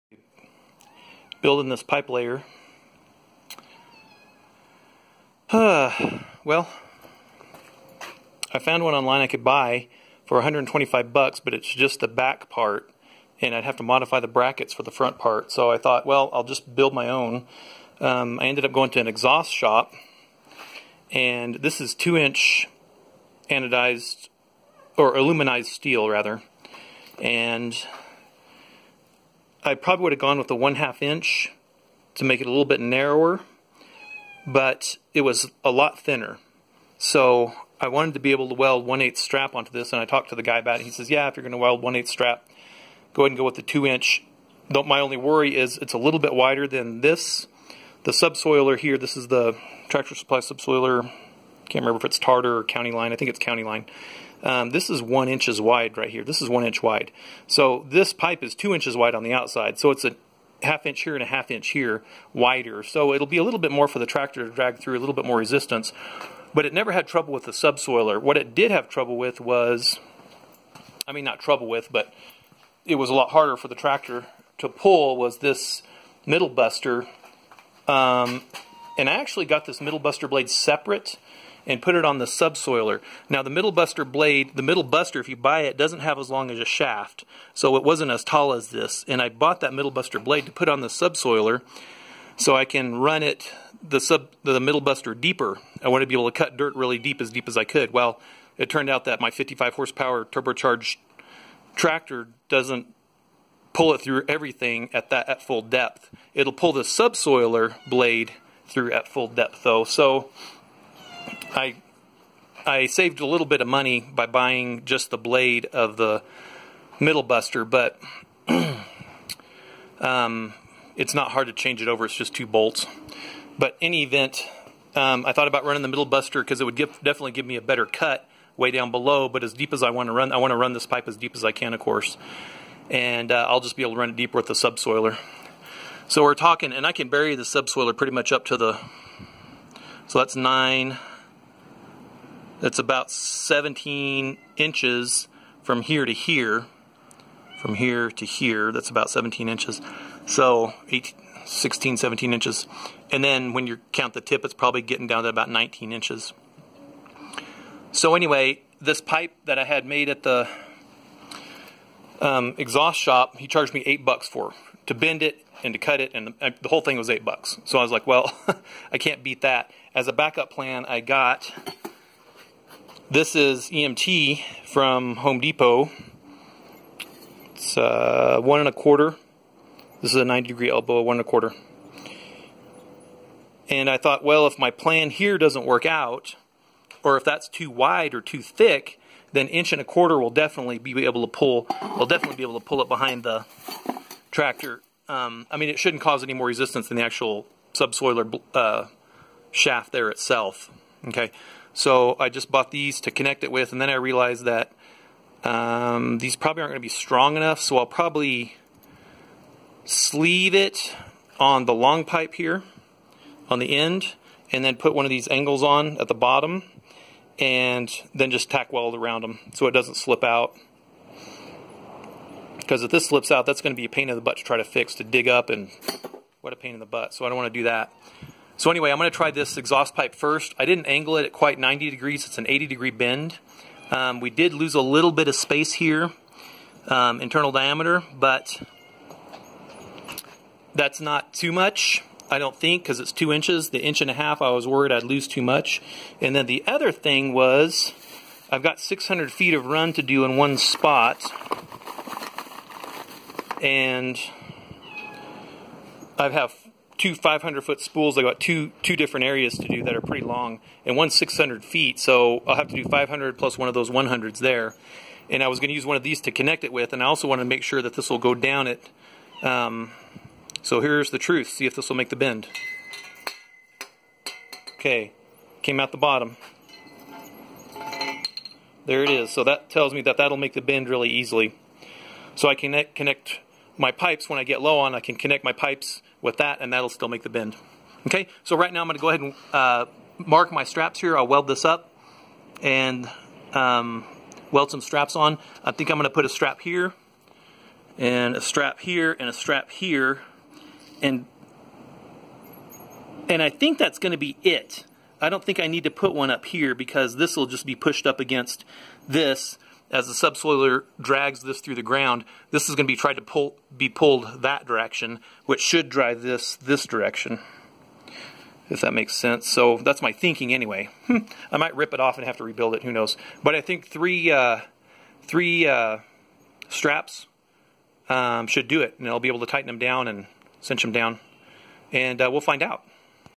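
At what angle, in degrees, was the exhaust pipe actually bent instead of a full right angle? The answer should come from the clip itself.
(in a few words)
80 degrees.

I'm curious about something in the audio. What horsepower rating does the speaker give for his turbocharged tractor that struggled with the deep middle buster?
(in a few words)
55.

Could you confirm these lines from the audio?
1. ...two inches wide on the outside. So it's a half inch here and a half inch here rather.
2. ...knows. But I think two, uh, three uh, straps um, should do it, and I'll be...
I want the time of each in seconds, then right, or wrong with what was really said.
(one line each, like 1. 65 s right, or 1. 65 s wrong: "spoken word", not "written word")
1. 58 s wrong: "wider", not "rather"
2. 322 s wrong: "three", not "two".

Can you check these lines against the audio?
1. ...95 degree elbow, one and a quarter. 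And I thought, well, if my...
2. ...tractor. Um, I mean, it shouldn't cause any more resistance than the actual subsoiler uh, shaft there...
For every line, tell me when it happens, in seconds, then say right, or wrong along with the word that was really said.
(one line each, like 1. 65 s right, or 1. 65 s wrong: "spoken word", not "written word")
1. 180 s wrong: "90", not "95"
2. 194 s right.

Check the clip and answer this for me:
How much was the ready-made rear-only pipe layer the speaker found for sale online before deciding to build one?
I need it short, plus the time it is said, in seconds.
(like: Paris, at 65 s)
$125, at 10 s.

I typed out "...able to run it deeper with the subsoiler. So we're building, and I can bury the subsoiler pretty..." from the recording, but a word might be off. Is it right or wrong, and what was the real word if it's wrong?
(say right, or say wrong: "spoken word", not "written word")
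wrong: "talking", not "building".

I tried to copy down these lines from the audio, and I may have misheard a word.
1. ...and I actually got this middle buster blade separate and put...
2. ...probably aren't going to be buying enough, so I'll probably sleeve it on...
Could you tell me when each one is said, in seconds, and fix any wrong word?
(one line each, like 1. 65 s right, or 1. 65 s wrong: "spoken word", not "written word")
1. 78 s right
2. 206 s wrong: "strong", not "buying".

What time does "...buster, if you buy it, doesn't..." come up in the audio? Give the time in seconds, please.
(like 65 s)
84 s.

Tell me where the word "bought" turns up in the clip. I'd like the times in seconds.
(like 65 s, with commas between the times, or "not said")
89 s, 202 s.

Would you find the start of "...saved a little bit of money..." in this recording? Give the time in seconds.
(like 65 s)
112 s.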